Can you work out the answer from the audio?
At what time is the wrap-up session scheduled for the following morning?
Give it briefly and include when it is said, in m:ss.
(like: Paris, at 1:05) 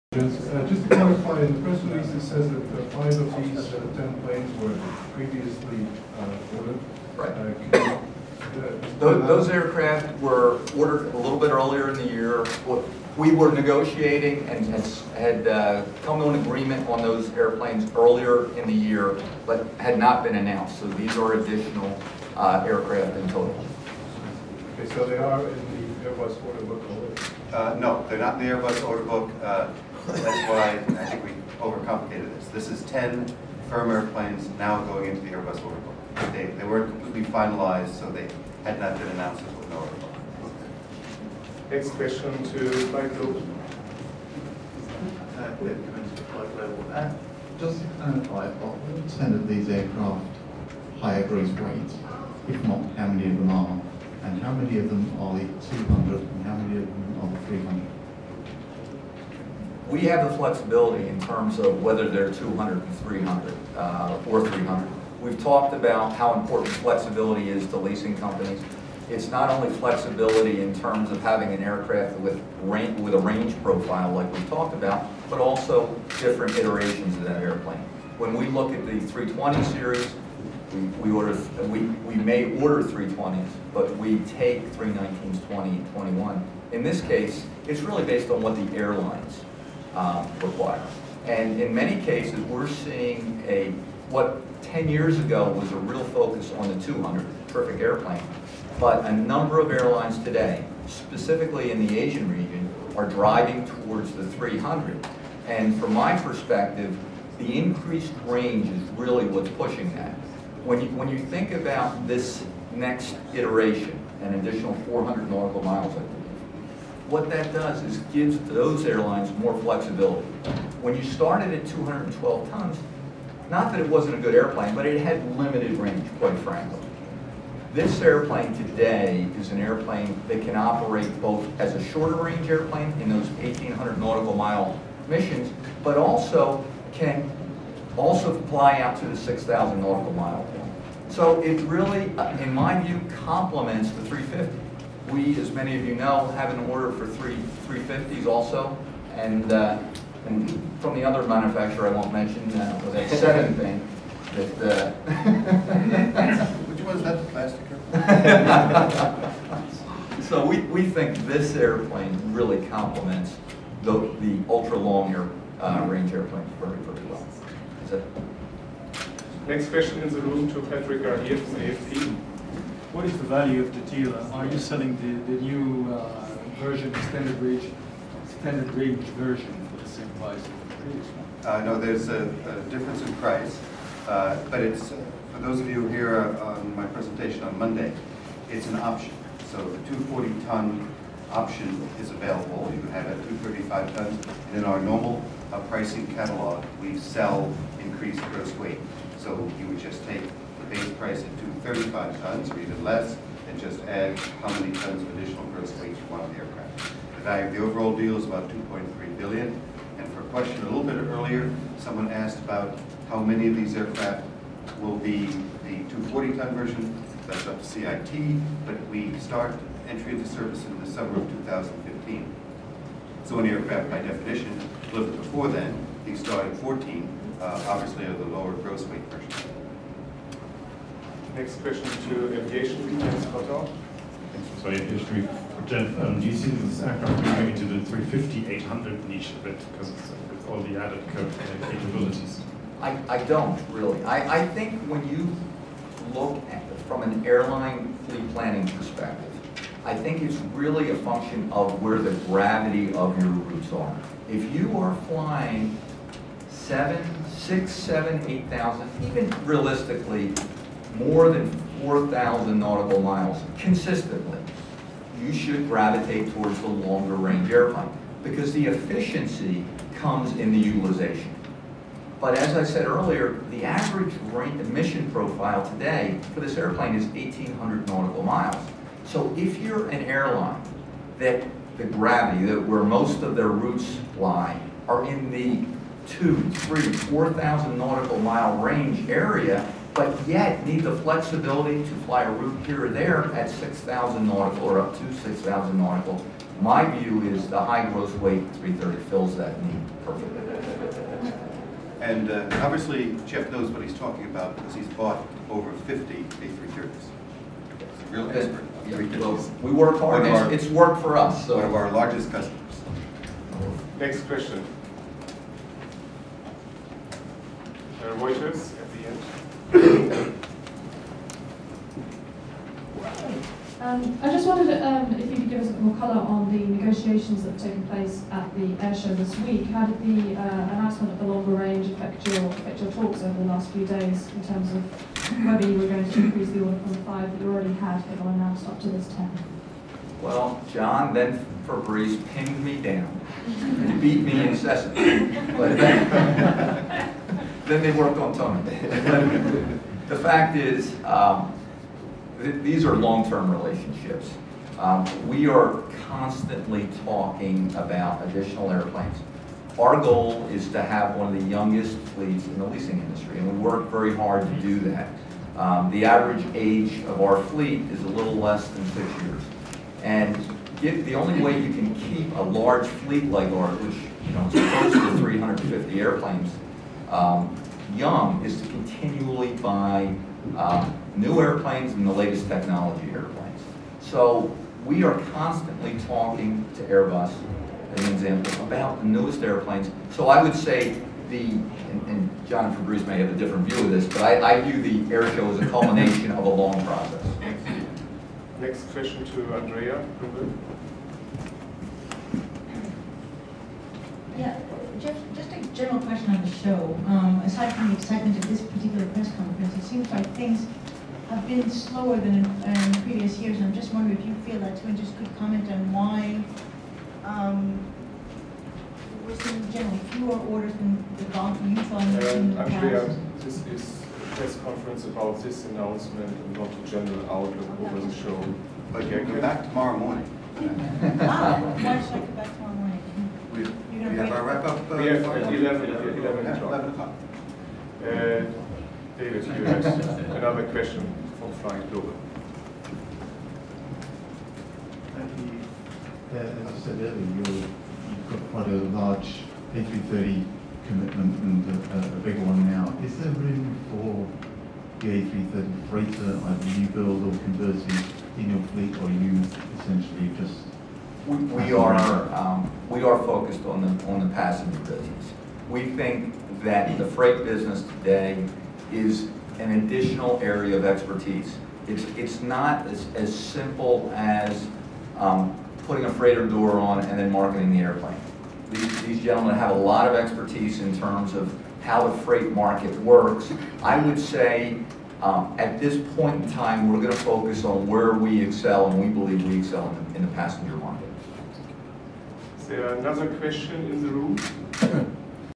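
11 o'clock, at 7:15.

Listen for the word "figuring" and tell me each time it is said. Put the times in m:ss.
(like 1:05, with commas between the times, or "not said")
not said.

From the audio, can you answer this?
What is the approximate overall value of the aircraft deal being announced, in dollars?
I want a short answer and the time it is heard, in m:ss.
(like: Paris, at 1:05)
2.3 billion, at 3:28.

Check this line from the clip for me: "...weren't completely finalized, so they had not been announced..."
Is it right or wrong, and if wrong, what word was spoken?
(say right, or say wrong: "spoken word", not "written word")
right.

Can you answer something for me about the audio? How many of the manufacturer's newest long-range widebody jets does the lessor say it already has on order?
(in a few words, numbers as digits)
3.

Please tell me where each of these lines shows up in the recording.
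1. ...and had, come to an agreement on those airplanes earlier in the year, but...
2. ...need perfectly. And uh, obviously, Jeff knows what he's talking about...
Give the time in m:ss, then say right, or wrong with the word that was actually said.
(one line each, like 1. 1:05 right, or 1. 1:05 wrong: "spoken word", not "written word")
1. 0:14 right
2. 4:59 right.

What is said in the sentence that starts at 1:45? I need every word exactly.
And from my perspective, the increased range is really what's pushing that.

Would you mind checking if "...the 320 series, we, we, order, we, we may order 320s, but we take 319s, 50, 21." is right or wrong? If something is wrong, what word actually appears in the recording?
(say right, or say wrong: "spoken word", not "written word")
wrong: "20", not "50".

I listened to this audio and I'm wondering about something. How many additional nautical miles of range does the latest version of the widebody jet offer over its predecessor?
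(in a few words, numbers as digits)
400.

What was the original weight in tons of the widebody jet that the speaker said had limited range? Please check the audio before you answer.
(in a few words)
212 tons.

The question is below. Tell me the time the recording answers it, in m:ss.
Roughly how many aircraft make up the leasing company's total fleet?
6:14.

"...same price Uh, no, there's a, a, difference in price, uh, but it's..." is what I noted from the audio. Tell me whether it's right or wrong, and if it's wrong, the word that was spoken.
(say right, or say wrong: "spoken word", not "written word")
right.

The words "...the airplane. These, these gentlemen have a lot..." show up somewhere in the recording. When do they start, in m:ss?
7:57.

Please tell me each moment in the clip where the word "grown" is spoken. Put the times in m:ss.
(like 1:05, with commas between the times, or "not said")
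not said.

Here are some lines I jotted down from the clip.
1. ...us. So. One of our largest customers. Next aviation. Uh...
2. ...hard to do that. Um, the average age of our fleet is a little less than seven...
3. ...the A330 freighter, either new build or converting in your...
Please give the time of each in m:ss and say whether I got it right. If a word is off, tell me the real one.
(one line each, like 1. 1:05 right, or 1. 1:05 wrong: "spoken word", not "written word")
1. 5:11 wrong: "question", not "aviation"
2. 6:04 wrong: "six", not "seven"
3. 7:35 right.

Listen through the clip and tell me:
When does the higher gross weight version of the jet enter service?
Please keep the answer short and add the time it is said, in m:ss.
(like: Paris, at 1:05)
Summer of 2015, at 3:40.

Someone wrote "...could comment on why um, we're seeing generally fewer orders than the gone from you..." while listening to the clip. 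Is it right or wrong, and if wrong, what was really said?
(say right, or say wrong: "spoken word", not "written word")
right.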